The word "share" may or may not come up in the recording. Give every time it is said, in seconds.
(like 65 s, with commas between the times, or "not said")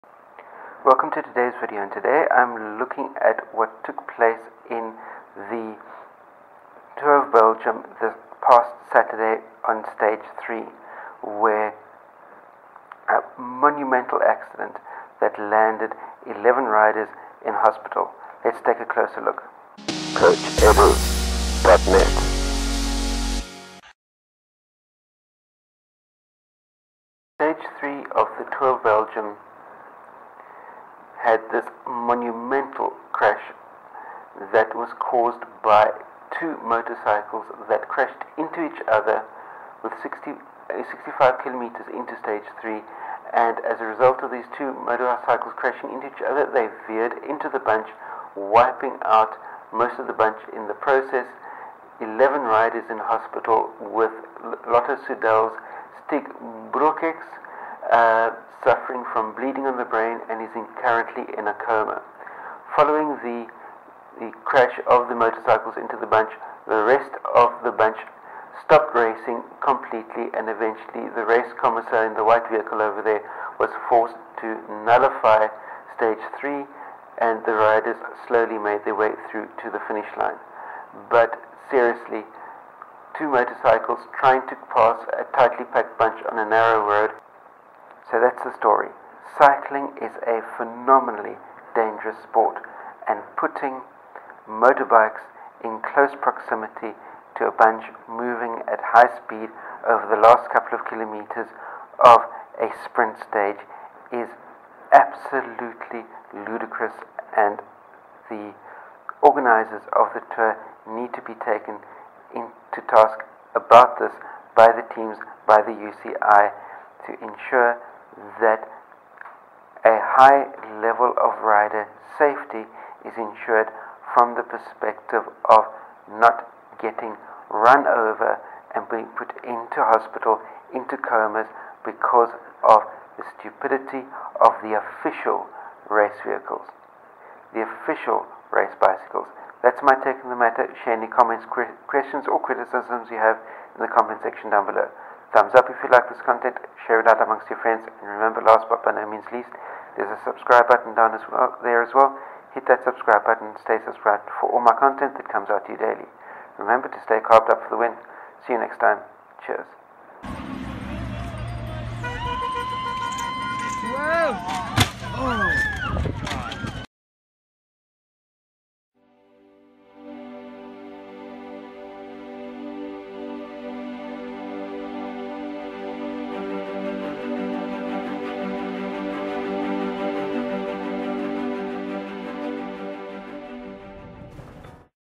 140 s, 146 s.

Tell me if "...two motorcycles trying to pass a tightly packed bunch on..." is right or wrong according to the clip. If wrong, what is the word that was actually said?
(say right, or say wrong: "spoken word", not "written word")
right.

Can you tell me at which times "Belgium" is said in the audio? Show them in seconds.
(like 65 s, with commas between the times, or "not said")
7 s, 28 s.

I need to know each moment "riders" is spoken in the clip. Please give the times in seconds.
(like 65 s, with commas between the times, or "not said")
16 s, 52 s, 77 s, 121 s.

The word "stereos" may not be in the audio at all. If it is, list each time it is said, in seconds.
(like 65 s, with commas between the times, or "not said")
not said.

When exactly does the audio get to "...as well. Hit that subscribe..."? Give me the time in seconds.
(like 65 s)
151 s.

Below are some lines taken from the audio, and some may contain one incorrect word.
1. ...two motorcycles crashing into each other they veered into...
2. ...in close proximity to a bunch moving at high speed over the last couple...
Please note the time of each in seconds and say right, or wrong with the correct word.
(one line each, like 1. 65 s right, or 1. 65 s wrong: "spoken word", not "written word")
1. 44 s right
2. 95 s right.